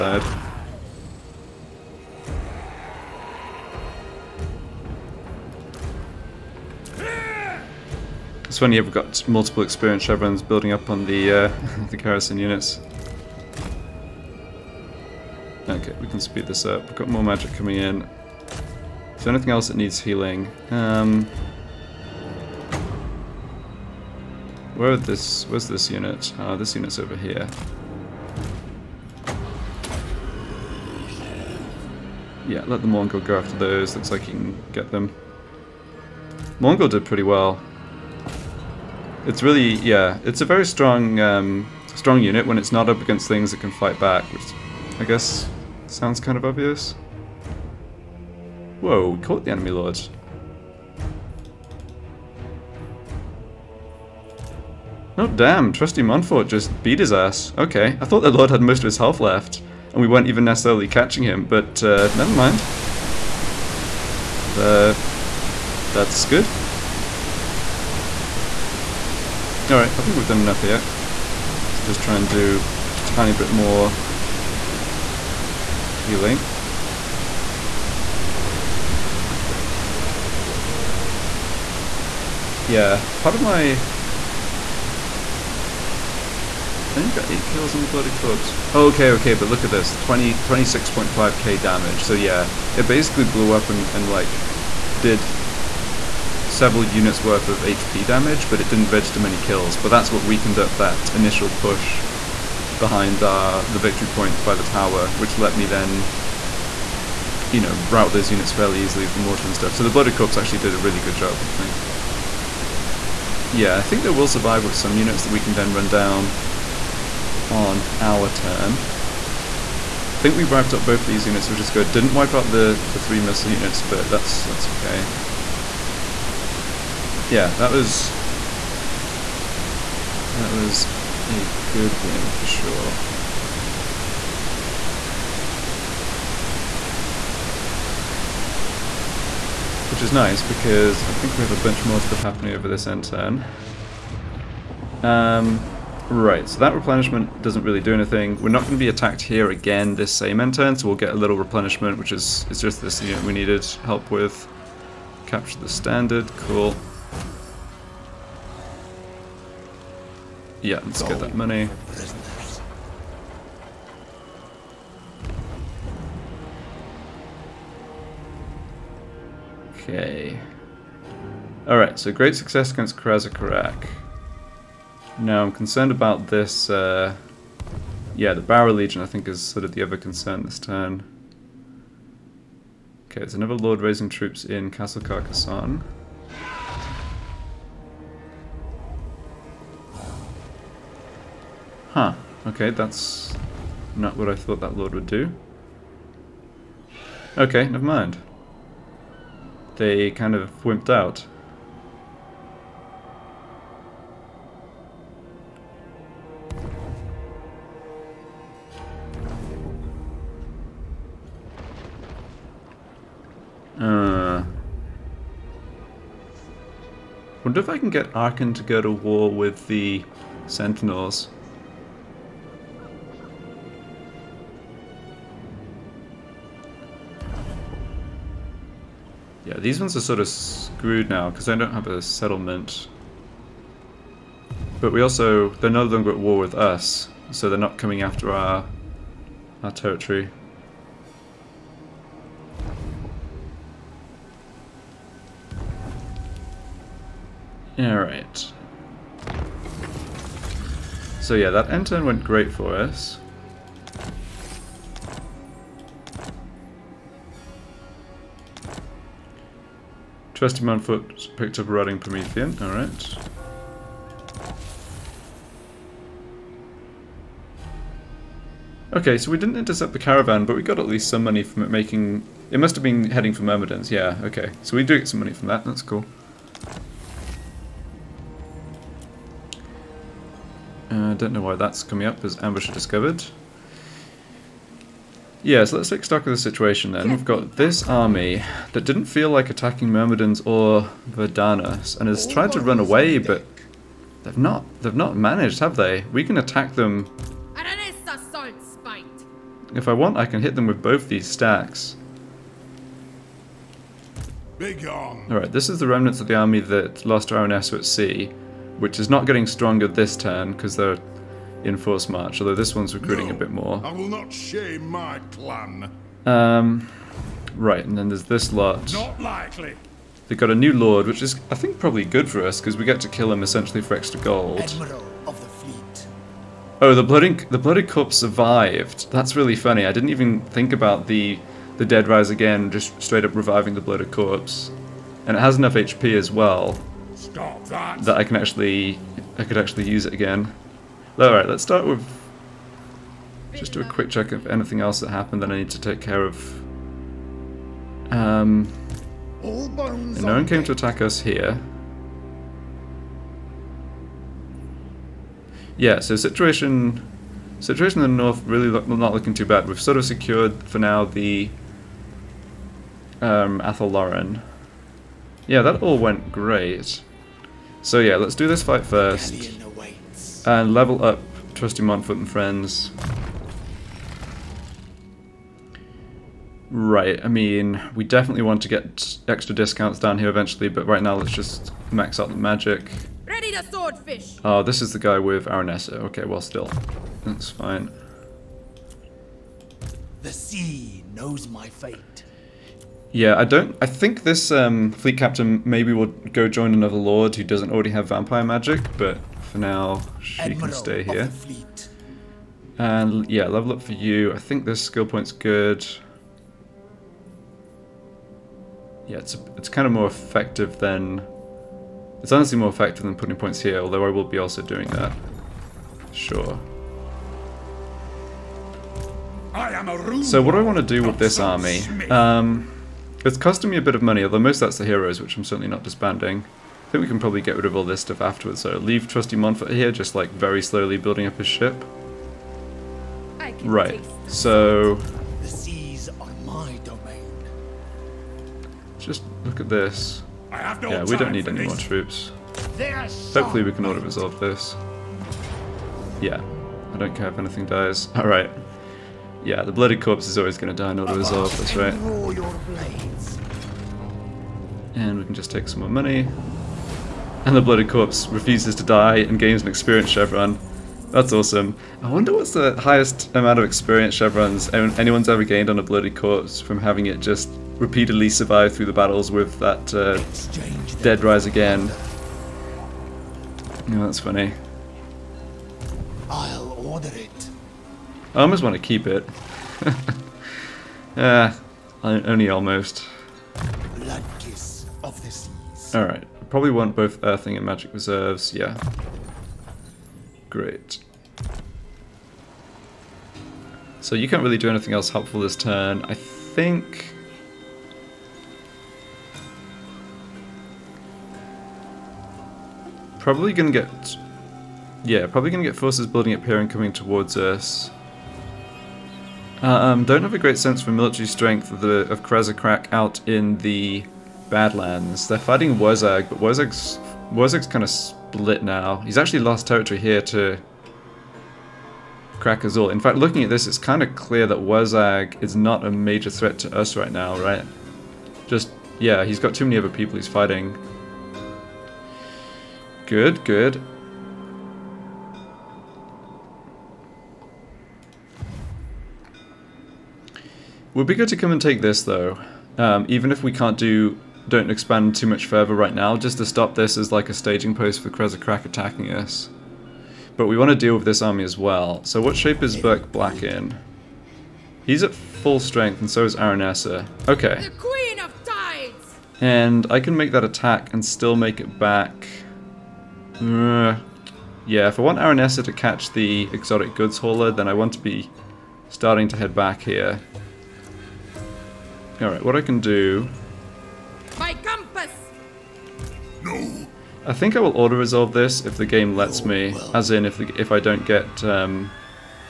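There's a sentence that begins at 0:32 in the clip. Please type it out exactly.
Yeah, let the Mourngul go after those.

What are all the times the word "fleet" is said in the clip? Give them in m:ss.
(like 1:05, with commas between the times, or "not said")
5:25, 6:34.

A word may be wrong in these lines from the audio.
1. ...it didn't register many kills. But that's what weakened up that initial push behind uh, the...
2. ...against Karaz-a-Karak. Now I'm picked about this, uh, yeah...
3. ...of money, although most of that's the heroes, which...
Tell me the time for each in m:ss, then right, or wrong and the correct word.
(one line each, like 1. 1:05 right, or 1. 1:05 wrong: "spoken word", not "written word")
1. 1:38 right
2. 2:52 wrong: "concerned", not "picked"
3. 7:03 right.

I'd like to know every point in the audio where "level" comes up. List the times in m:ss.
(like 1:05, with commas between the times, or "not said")
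6:10, 6:43.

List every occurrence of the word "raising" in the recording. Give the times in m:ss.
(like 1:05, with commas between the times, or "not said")
3:03.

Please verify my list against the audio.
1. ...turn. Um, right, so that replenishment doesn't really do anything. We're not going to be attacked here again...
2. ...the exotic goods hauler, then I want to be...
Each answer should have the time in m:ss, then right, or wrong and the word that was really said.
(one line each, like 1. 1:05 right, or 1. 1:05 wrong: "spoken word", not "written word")
1. 2:23 right
2. 9:26 right.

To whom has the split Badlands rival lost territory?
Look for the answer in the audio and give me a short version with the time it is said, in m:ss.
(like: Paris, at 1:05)
Krakazul, at 8:42.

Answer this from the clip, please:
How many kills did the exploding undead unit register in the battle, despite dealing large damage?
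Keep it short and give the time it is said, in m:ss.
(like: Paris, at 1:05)
8, at 1:27.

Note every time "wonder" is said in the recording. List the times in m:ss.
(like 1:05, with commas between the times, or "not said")
3:37, 7:42.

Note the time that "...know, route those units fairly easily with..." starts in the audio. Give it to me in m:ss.
1:47.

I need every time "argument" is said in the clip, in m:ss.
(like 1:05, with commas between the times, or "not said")
not said.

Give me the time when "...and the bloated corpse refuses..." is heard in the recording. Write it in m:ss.
7:37.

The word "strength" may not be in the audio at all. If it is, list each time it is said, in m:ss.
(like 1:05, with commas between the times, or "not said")
8:31, 9:15.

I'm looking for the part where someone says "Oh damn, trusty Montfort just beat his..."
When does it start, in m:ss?
0:55.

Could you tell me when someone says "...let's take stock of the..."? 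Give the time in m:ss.
4:45.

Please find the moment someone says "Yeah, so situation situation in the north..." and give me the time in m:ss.
5:55.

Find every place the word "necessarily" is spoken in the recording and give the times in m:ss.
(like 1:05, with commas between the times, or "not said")
1:00.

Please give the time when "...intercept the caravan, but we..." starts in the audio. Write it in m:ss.
4:29.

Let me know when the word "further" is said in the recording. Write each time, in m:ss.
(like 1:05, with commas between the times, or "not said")
9:05.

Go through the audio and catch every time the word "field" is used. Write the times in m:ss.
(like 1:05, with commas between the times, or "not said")
not said.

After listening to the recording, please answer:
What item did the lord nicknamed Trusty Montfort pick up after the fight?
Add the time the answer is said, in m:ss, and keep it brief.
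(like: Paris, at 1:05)
a rotting Promethean, at 4:21.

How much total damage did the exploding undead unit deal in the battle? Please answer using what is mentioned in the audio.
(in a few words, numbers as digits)
26.5k.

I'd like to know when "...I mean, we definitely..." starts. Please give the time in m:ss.
6:17.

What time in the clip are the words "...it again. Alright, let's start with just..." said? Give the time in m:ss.
5:40.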